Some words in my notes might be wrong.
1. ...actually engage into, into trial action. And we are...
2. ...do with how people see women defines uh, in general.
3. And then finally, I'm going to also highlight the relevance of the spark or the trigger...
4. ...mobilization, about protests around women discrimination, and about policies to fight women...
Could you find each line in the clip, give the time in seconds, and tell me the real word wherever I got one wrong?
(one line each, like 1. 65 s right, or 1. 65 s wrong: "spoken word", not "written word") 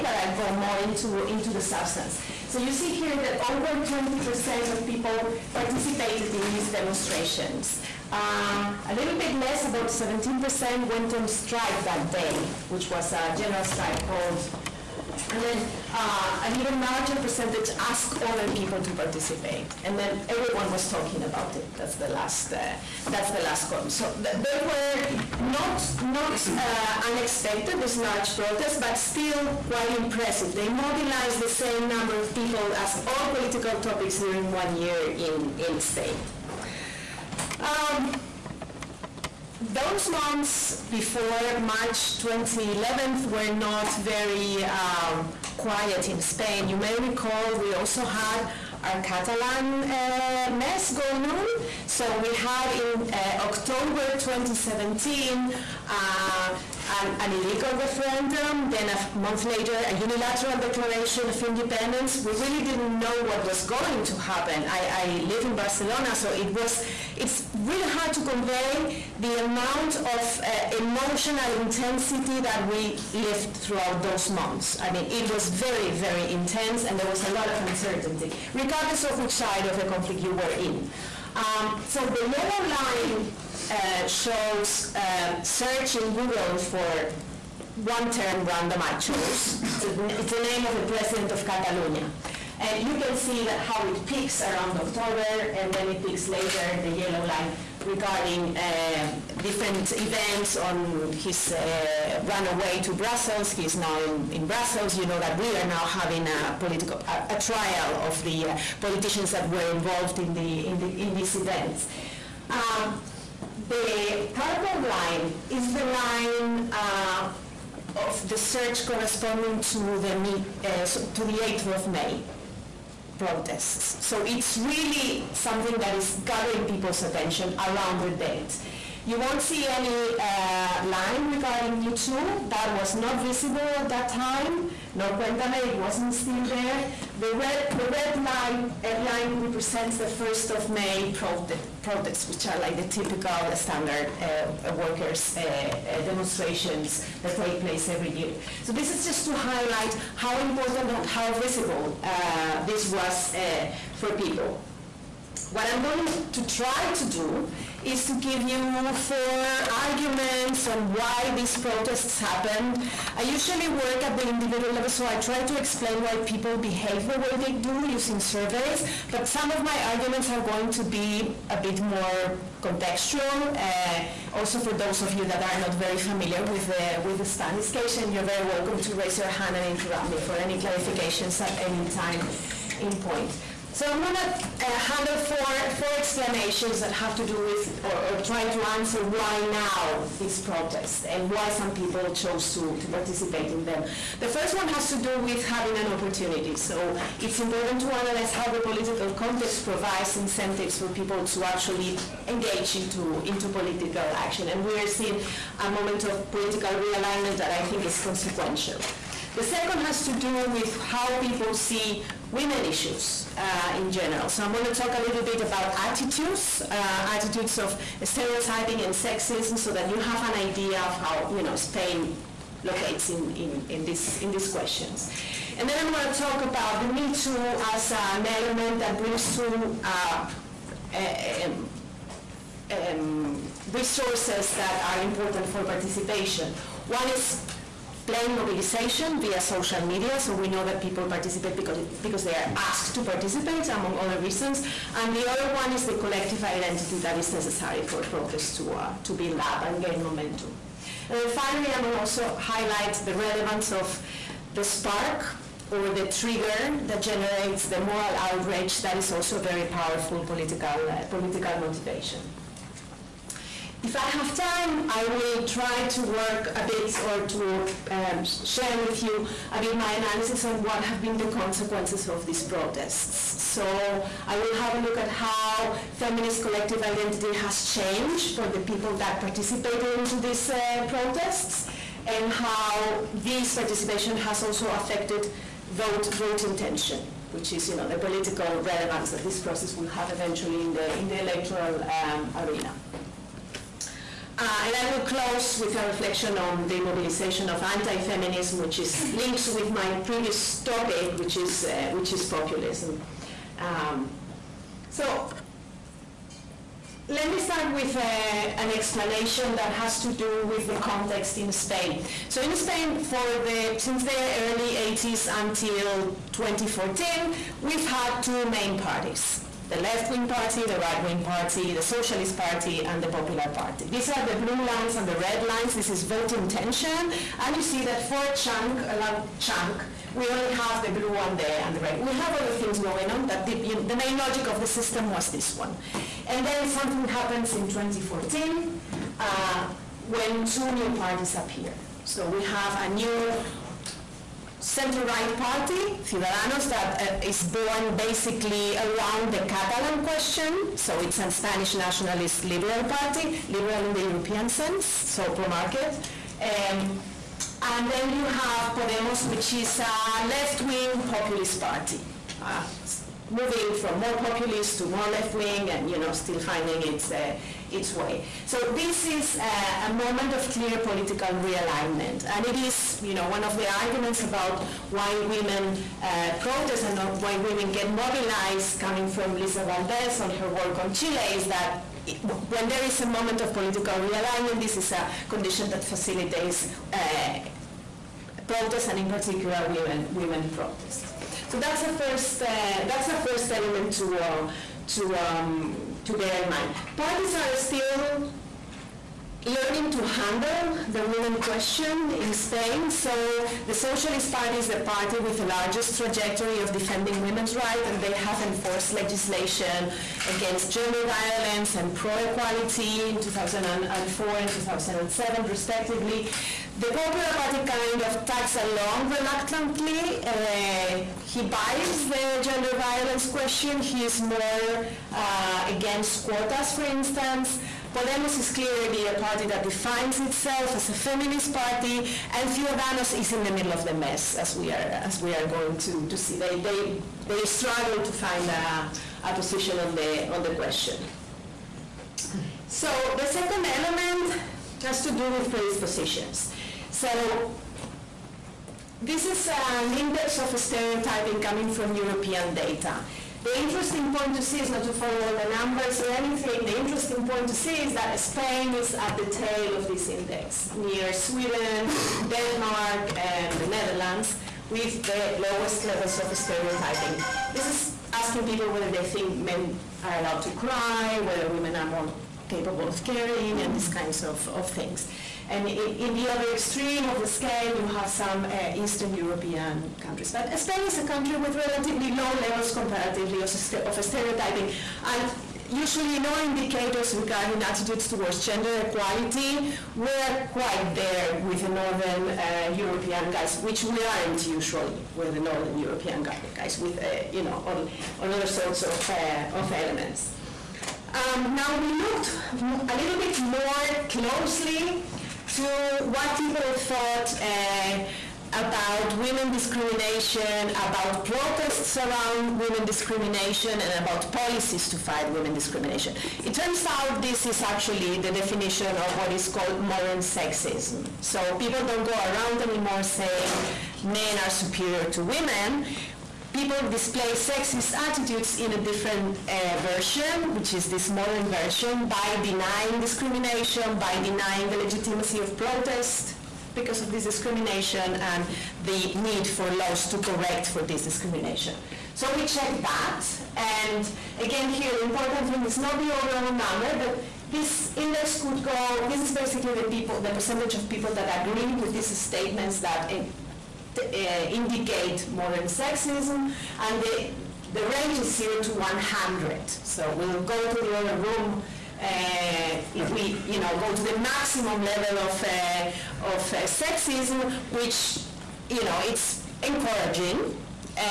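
1. 201 s wrong: "political", not "trial"
2. 210 s wrong: "issues", not "defines"
3. 251 s right
4. 509 s wrong: "discrimination", not "mobilization".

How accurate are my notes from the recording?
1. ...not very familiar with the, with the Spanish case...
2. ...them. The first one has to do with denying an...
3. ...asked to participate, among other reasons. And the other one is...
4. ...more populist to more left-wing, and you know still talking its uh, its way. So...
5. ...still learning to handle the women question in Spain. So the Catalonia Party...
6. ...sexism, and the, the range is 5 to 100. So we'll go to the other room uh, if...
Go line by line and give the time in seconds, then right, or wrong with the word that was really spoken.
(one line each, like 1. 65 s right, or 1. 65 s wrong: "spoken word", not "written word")
1. 175 s right
2. 193 s wrong: "having", not "denying"
3. 242 s right
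4. 363 s wrong: "finding", not "talking"
5. 397 s wrong: "Socialist", not "Catalonia"
6. 555 s wrong: "0", not "5".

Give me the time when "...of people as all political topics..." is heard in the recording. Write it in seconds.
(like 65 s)
32 s.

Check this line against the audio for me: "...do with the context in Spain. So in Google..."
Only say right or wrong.
wrong.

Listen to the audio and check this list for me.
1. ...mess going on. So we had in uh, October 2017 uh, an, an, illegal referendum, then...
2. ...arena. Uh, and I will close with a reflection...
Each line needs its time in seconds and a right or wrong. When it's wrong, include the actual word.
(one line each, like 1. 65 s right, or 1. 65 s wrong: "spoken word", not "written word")
1. 50 s right
2. 292 s right.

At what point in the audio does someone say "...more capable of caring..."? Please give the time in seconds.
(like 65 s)
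471 s.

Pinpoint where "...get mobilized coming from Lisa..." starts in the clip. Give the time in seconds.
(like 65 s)
377 s.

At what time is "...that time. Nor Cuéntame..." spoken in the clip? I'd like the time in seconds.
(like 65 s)
133 s.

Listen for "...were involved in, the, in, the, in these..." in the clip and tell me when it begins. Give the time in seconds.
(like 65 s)
109 s.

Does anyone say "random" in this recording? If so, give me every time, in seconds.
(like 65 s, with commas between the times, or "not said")
88 s.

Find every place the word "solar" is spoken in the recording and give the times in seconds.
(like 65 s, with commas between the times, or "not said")
not said.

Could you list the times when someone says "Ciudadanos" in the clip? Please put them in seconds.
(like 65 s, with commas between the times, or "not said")
346 s, 432 s.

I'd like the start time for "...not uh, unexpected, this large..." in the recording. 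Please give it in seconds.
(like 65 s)
26 s.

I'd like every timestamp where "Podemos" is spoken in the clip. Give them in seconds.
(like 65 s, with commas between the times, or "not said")
358 s, 427 s.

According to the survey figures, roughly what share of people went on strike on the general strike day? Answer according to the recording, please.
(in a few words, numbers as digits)
17%.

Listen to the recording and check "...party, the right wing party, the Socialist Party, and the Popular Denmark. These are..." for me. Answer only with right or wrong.
wrong.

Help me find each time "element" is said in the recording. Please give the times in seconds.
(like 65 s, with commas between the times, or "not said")
228 s, 393 s, 443 s, 499 s.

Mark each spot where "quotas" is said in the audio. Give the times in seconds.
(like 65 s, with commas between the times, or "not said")
426 s.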